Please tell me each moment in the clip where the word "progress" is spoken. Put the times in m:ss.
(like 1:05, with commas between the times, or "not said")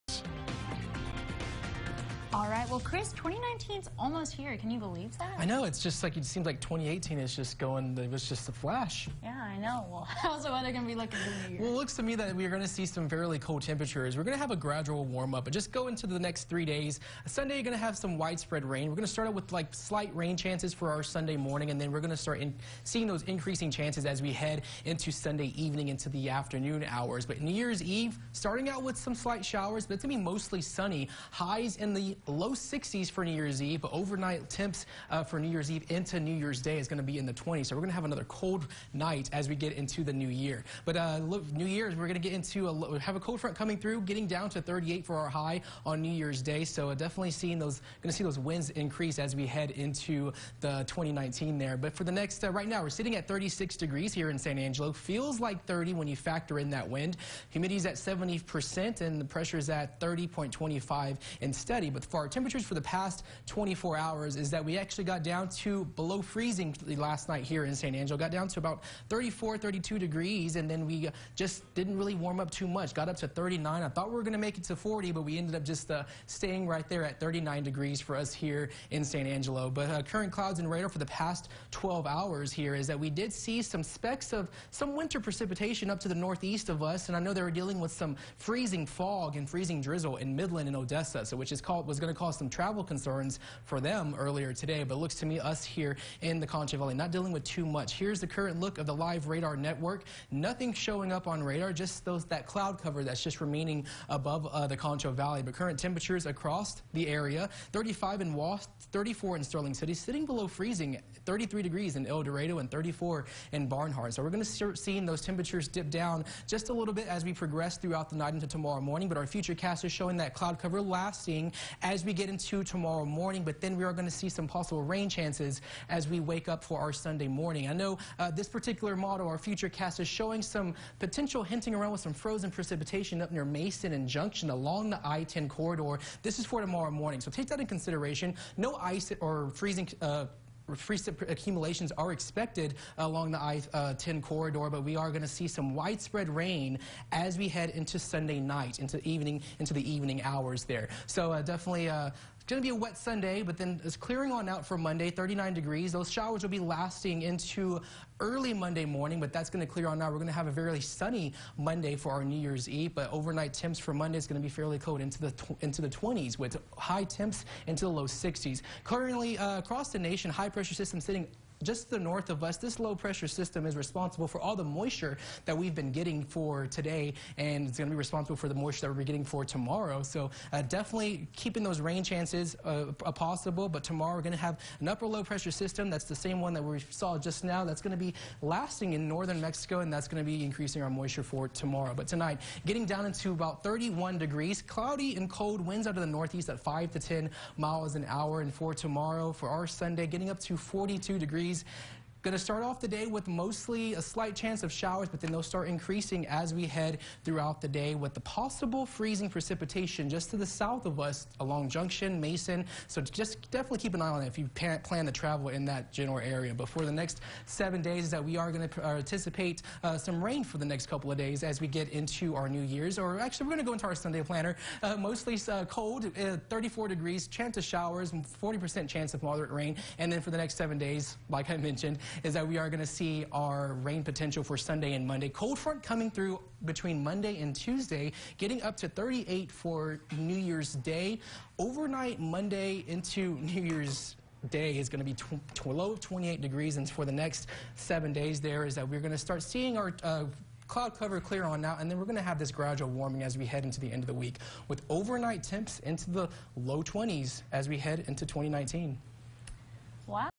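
1:57.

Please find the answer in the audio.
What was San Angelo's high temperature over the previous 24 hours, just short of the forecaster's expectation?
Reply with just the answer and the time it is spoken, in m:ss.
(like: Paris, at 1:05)
39, at 1:12.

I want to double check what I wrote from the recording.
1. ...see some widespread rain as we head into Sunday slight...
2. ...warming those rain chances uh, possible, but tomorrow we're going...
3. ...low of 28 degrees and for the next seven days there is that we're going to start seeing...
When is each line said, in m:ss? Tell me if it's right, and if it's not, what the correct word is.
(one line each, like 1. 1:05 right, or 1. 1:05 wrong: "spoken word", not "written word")
1. 2:25 wrong: "night", not "slight"
2. 3:01 wrong: "keeping", not "warming"
3. 4:05 right.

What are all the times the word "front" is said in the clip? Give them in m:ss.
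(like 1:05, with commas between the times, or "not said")
0:43, 3:55.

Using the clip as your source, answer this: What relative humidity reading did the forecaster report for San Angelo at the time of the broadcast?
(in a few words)
70%.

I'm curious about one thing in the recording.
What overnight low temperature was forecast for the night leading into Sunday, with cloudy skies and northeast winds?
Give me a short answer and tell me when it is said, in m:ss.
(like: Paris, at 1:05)
31 degrees, at 3:13.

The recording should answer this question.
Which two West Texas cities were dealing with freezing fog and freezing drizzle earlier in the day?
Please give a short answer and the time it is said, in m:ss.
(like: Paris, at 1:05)
Midland and Odessa, at 1:30.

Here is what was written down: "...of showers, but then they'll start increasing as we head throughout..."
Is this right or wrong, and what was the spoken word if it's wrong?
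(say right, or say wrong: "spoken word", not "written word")
right.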